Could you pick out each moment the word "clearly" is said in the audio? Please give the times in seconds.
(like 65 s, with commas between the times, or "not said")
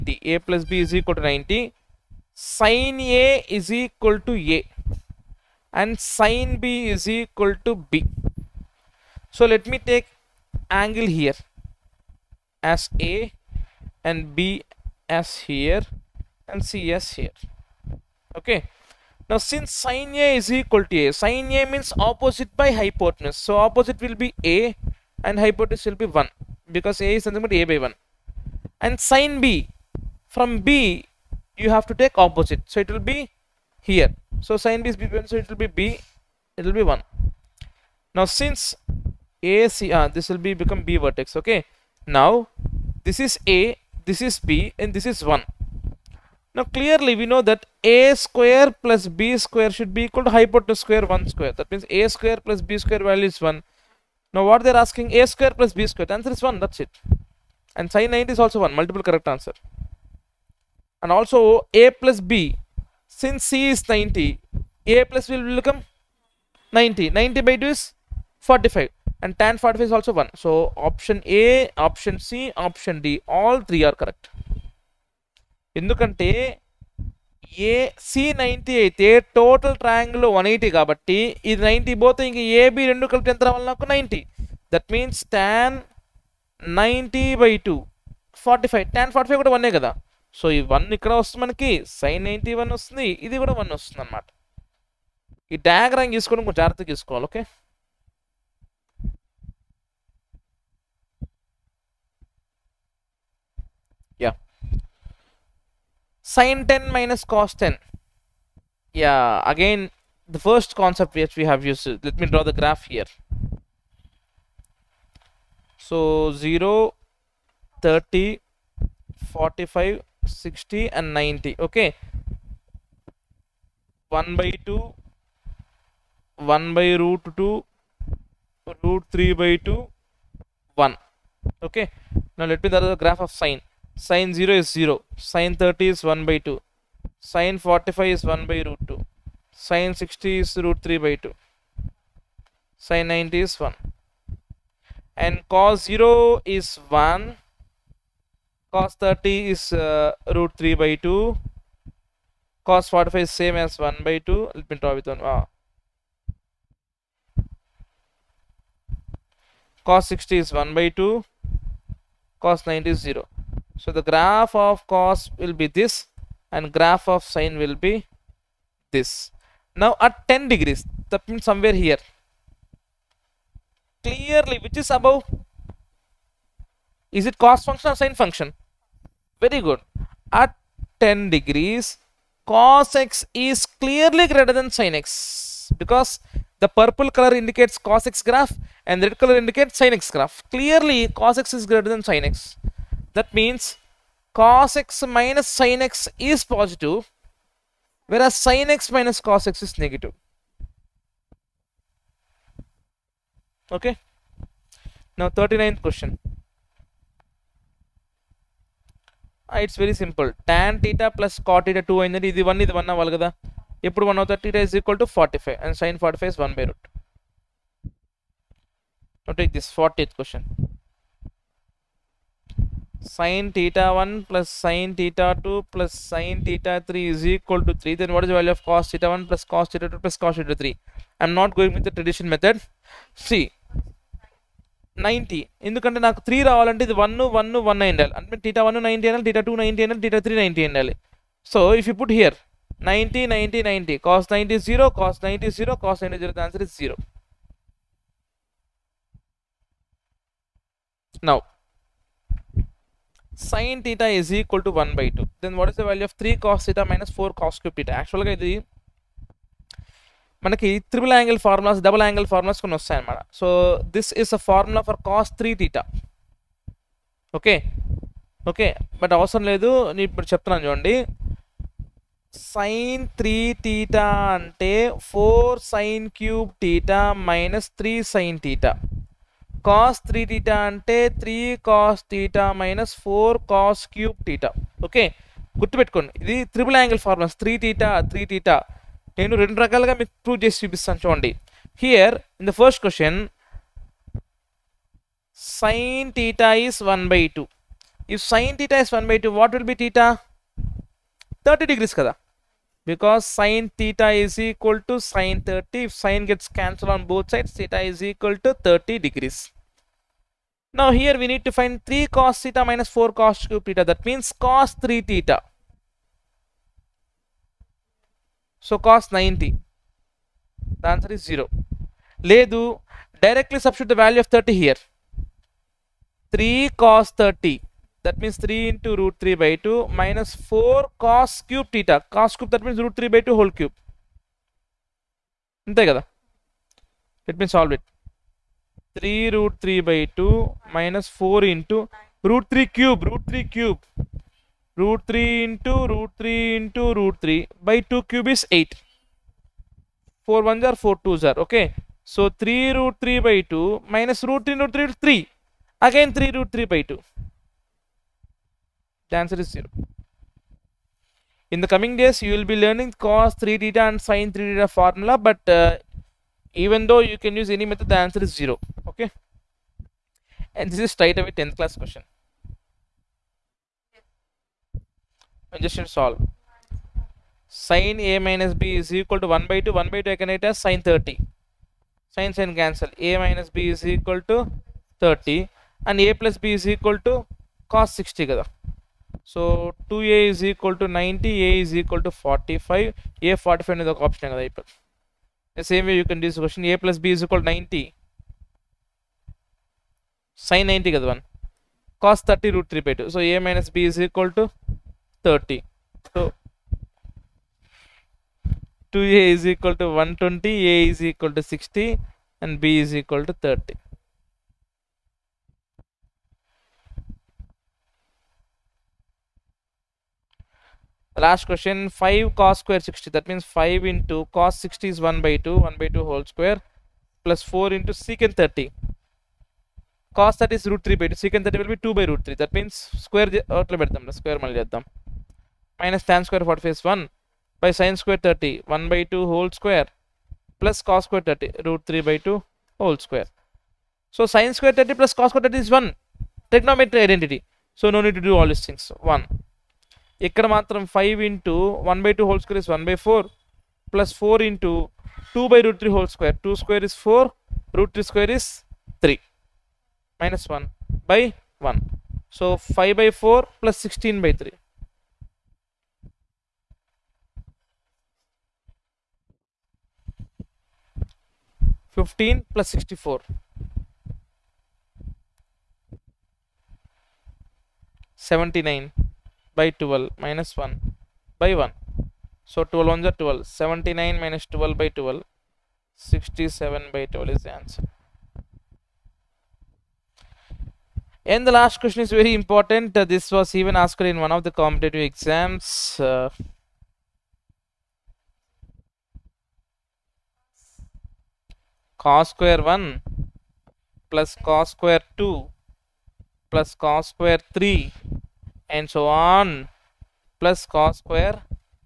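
46 s, 174 s, 183 s, 190 s.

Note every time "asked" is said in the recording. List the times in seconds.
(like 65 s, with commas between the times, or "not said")
493 s.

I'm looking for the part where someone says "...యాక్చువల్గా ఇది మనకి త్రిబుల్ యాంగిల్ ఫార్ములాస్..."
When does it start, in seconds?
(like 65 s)
257 s.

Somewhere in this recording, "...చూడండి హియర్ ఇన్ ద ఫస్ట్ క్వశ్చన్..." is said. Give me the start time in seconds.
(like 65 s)
291 s.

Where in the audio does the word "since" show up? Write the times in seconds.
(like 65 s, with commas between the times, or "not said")
19 s, 38 s, 63 s.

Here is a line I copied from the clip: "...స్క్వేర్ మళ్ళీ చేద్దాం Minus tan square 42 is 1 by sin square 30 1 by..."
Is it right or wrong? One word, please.
wrong.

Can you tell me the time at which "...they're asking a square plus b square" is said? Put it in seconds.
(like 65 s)
54 s.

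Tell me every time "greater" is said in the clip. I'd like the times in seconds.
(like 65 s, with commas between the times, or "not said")
184 s, 191 s.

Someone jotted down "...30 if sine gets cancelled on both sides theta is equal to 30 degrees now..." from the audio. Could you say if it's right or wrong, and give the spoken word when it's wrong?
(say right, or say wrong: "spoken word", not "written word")
right.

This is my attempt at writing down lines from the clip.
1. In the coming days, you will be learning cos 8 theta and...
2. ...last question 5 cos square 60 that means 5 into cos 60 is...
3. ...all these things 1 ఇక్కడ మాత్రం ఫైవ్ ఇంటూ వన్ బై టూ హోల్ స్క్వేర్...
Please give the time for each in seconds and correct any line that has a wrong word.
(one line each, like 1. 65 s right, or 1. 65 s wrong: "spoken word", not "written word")
1. 361 s wrong: "3", not "8"
2. 421 s right
3. 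448 s right.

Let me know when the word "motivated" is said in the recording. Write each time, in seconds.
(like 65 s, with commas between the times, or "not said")
not said.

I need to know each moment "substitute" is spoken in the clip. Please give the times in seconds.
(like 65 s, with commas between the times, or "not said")
323 s.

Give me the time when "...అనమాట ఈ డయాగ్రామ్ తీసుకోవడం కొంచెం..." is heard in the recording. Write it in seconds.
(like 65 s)
94 s.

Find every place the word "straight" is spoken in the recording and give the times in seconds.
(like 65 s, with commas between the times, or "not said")
370 s.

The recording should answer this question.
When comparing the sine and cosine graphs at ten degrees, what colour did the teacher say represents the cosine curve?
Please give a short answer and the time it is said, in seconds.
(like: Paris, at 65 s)
Purple, at 186 s.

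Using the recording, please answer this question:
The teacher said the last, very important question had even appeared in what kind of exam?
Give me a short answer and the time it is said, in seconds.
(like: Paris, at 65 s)
Competitive exams, at 494 s.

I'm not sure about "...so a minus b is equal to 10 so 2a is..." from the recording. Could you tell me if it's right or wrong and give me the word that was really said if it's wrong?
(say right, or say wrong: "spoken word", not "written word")
wrong: "30", not "10".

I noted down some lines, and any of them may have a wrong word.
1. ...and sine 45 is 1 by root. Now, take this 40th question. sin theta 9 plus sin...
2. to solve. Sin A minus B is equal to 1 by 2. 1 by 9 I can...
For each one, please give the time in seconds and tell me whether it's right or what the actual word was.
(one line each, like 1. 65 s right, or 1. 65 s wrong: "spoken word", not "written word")
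1. 215 s wrong: "1", not "9"
2. 375 s wrong: "2", not "9".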